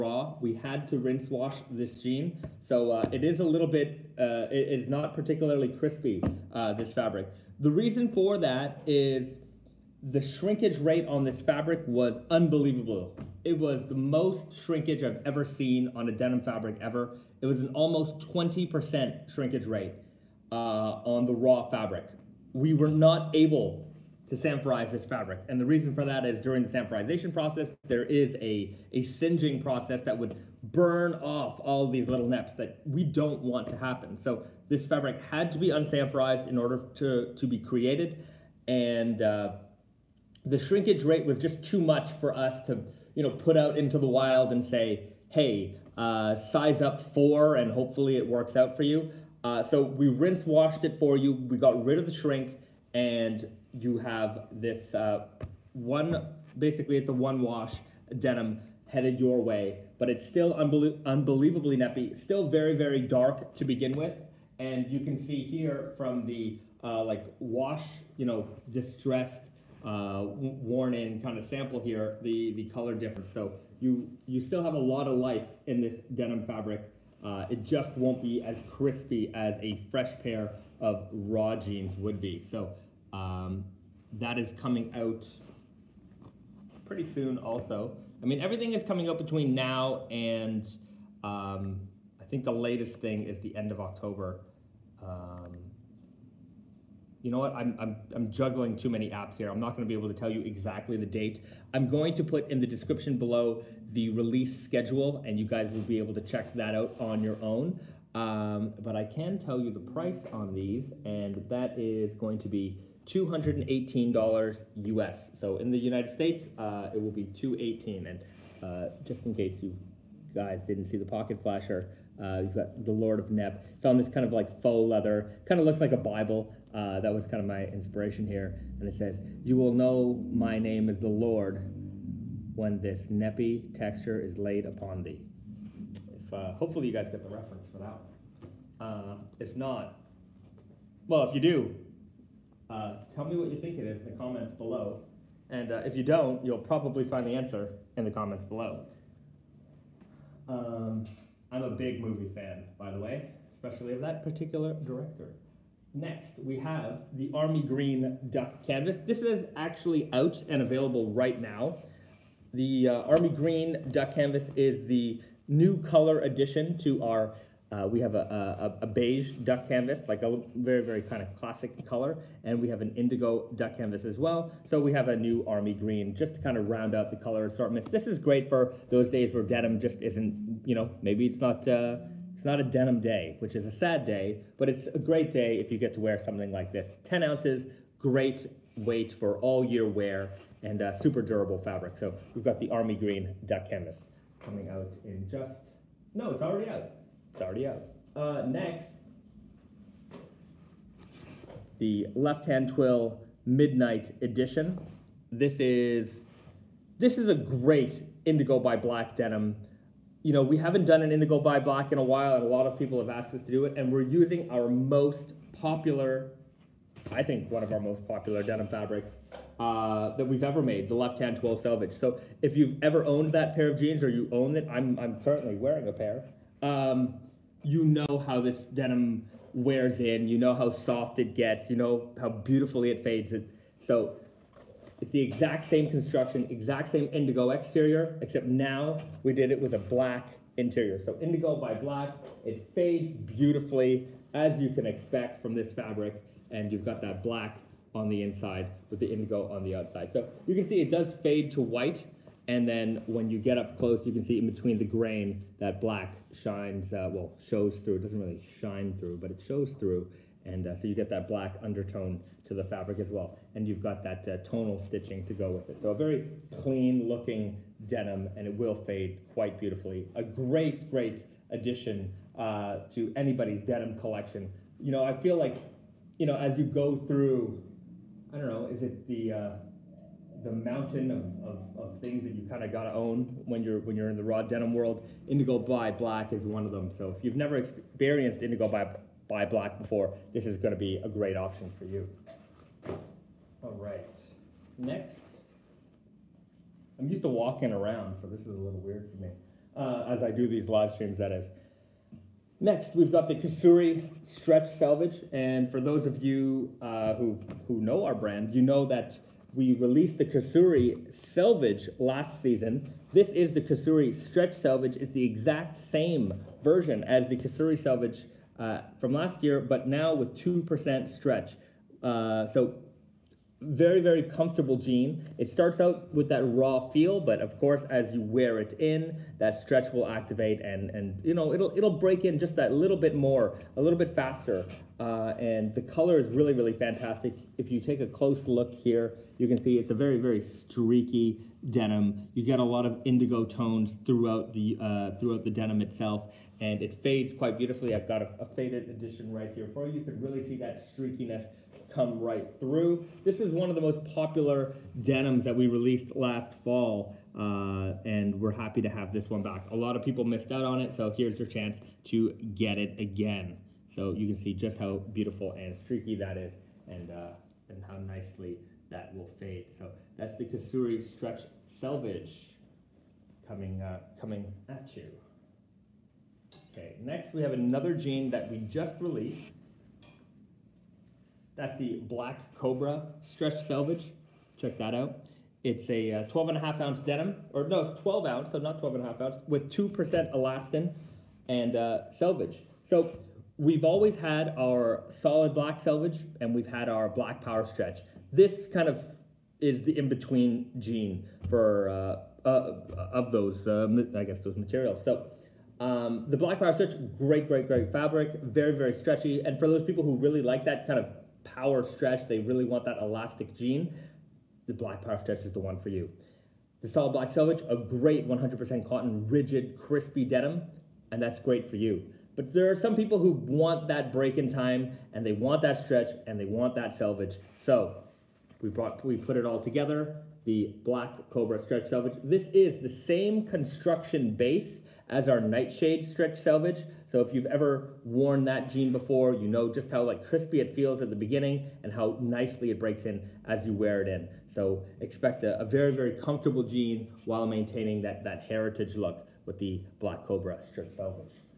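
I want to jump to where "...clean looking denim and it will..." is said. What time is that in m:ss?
4:26.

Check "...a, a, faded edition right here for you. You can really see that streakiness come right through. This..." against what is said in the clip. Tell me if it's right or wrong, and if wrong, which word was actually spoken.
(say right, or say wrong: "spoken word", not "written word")
right.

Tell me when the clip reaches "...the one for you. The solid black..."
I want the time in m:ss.
6:55.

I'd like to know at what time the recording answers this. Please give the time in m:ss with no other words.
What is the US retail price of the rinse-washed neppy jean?
1:53.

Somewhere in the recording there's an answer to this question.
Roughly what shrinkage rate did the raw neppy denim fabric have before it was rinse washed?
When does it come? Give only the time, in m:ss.
0:17.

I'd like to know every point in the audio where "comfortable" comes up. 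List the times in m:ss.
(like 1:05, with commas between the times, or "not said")
5:24, 7:26.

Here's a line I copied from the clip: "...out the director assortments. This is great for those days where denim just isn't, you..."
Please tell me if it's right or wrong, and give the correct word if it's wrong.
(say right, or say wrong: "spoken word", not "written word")
wrong: "color", not "director".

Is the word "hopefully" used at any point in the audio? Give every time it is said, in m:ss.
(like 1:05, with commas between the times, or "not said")
0:47, 2:16.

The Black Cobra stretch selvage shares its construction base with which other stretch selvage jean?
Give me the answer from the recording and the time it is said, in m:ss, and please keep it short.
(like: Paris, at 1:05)
Nightshade stretch selvage, at 7:15.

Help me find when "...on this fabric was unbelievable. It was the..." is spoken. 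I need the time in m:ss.
0:11.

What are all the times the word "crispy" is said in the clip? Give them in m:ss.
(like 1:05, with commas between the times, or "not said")
0:05, 1:18, 6:59, 7:20.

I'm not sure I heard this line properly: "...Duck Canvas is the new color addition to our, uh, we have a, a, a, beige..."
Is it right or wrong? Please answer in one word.
right.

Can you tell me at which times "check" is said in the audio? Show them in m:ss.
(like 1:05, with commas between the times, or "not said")
1:46, 6:24.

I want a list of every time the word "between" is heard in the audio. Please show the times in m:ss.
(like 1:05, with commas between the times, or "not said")
1:29, 4:14, 6:39.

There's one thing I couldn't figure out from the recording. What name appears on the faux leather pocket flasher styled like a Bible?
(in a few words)
Lord of Nep.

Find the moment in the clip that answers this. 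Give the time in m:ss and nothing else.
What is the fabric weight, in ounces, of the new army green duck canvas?
3:07.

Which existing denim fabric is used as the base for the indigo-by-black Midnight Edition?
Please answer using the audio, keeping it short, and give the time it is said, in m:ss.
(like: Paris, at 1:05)
Left-hand 12 selvage, at 3:40.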